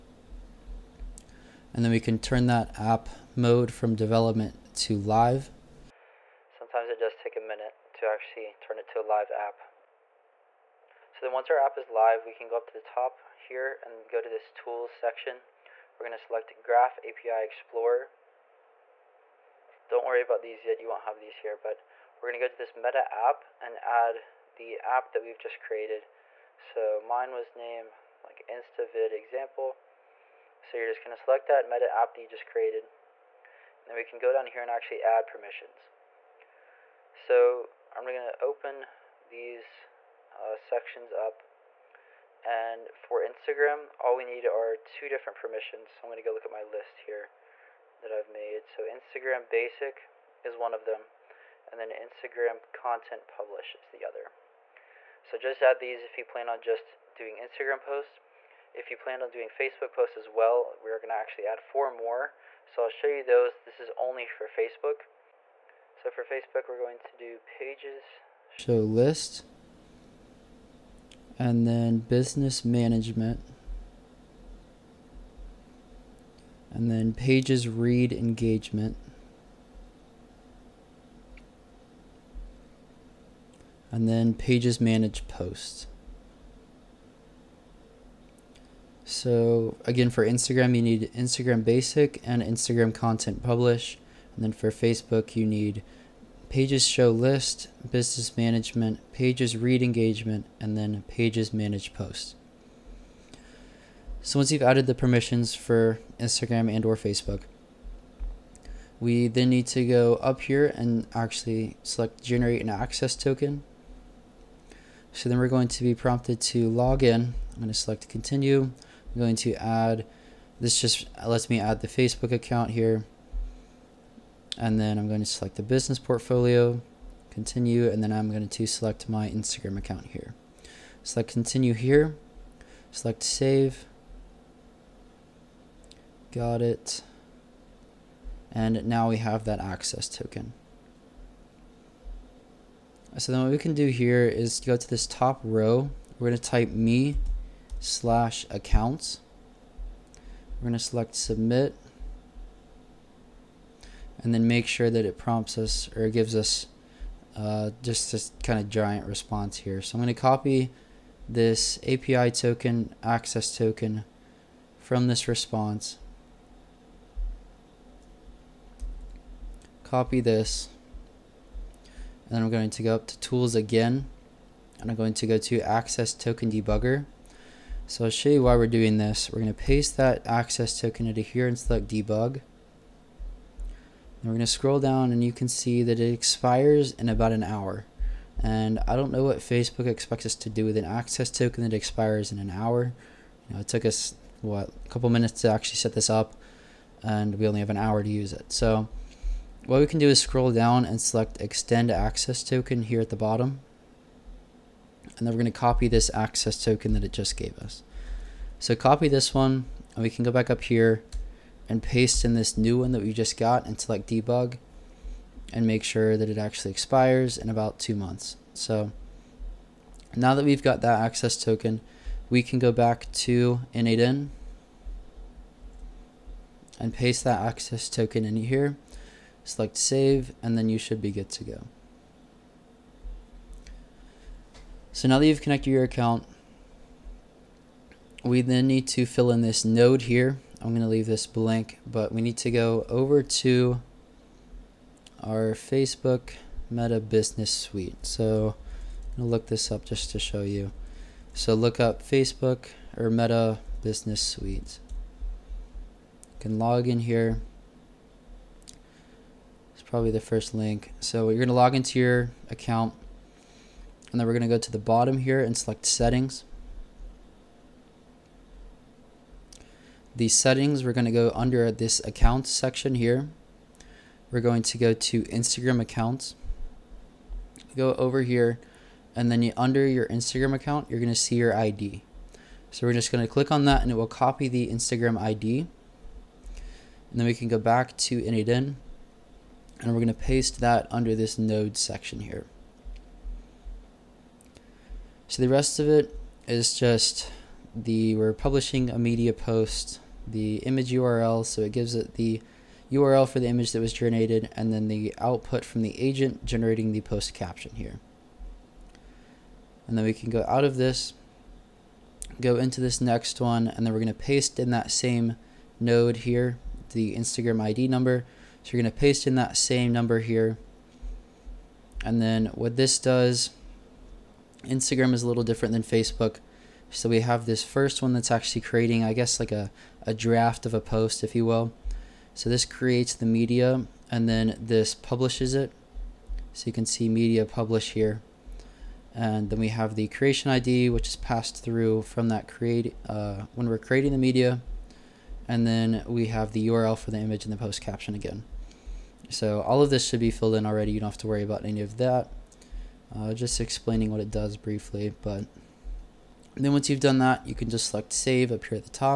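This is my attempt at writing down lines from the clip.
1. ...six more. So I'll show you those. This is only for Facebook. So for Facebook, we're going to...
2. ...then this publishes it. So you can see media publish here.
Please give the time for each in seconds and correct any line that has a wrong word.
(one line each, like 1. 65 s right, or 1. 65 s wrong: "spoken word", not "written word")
1. 61 s wrong: "four", not "six"
2. 334 s right.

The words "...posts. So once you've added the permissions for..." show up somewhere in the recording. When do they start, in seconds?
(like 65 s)
101 s.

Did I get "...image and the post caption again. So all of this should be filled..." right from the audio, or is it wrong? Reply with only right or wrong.
right.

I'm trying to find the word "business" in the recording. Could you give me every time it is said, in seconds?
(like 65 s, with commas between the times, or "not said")
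71 s, 97 s, 125 s, 247 s, 253 s.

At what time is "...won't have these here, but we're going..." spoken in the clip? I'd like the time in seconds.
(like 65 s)
20 s.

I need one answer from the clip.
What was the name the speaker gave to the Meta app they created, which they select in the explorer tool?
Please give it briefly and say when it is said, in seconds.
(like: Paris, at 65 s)
InstaVid example, at 28 s.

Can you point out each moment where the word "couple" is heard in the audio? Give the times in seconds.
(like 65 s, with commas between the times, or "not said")
194 s.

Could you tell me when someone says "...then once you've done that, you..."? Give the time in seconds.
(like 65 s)
356 s.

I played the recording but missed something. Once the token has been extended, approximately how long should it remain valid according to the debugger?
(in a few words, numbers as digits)
about two months.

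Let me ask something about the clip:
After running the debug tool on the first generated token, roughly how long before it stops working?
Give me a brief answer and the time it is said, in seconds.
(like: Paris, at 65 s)
about an hour, at 187 s.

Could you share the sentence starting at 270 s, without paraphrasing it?
the settings, we're going to go under this account section here.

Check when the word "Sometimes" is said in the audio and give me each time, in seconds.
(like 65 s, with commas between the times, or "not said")
6 s.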